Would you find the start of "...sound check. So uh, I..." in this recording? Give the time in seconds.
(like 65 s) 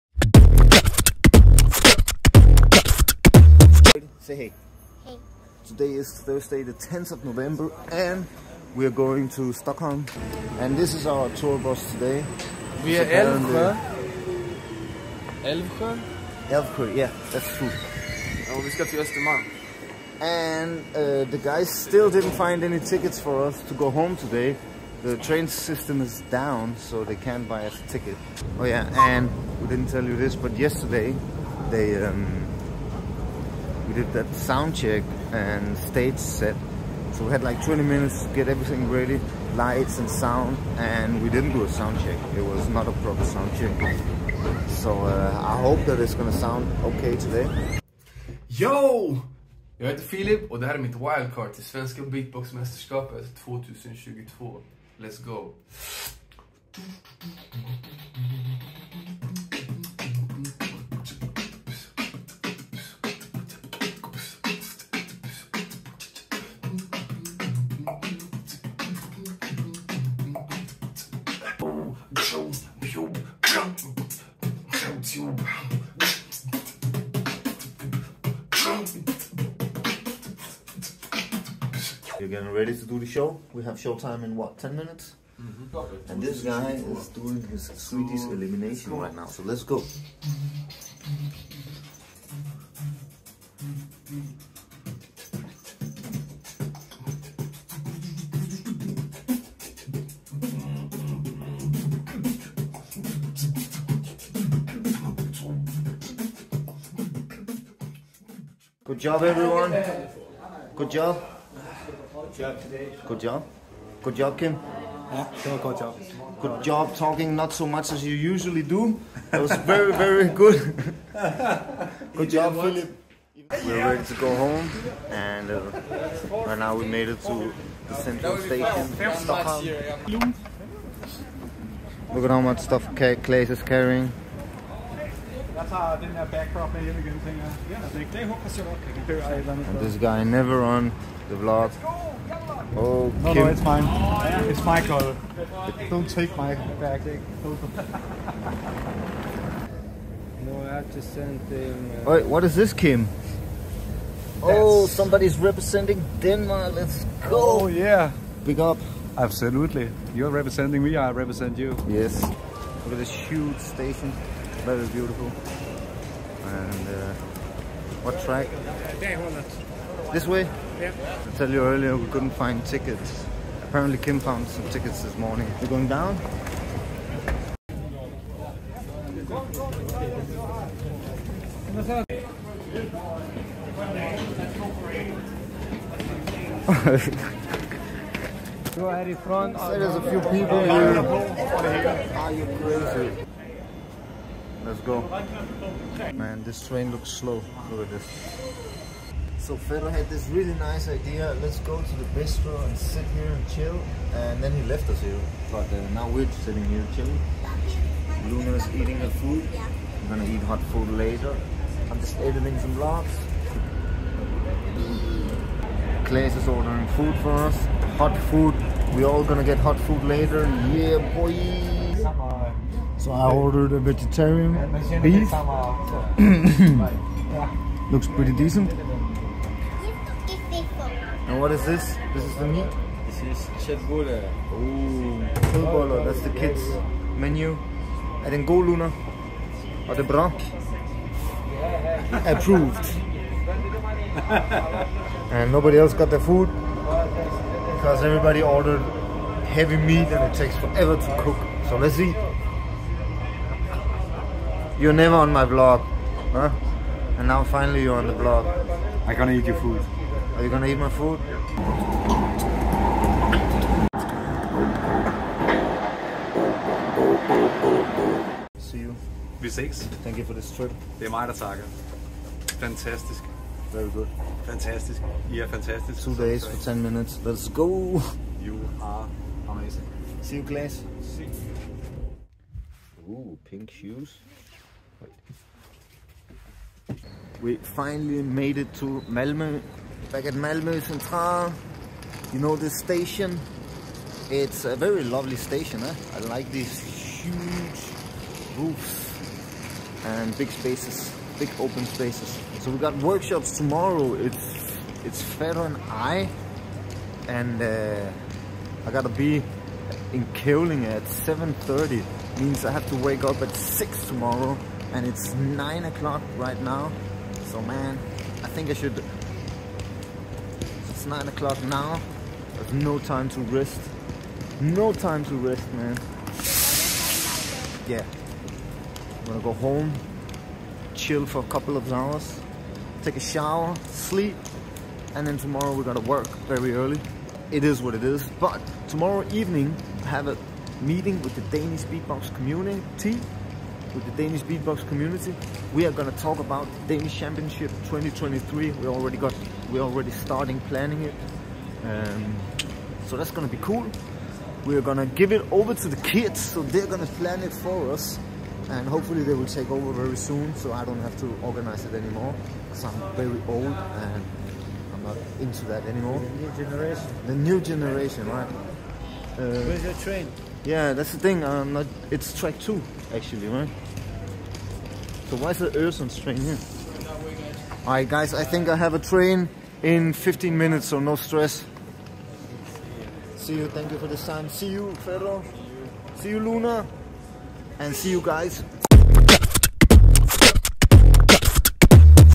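43 s.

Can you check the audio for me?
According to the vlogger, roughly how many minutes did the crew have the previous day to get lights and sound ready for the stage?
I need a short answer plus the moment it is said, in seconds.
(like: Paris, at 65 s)
20 minutes, at 37 s.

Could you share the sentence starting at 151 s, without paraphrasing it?
Uh, Wait, what is this, Kim?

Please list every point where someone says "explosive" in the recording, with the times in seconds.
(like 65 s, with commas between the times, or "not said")
not said.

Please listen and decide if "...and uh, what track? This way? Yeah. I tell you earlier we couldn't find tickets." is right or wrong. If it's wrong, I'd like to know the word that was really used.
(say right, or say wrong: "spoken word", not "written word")
right.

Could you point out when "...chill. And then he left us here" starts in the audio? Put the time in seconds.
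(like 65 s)
203 s.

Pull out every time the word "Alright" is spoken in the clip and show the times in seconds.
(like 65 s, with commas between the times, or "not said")
377 s.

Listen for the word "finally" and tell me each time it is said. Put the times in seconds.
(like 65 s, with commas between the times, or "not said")
257 s, 287 s.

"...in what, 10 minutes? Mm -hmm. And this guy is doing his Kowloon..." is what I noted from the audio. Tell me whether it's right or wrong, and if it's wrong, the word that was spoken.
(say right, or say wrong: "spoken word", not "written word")
wrong: "Swedish", not "Kowloon".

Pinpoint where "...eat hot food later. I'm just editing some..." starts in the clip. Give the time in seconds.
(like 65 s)
210 s.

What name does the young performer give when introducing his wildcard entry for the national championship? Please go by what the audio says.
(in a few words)
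Filip.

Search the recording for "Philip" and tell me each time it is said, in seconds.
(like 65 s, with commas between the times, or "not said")
122 s.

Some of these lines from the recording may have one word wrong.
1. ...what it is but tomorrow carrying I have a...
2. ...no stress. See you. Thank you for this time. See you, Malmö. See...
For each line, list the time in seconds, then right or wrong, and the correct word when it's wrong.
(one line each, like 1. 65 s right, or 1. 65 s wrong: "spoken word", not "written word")
1. 337 s wrong: "evening", not "carrying"
2. 380 s wrong: "Ferro", not "Malmö".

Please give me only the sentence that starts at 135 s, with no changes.
That's how I didn't have backdrop and everything.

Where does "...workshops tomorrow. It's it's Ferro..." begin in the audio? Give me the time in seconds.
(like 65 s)
303 s.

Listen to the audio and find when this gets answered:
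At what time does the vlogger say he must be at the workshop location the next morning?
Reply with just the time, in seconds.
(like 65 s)
311 s.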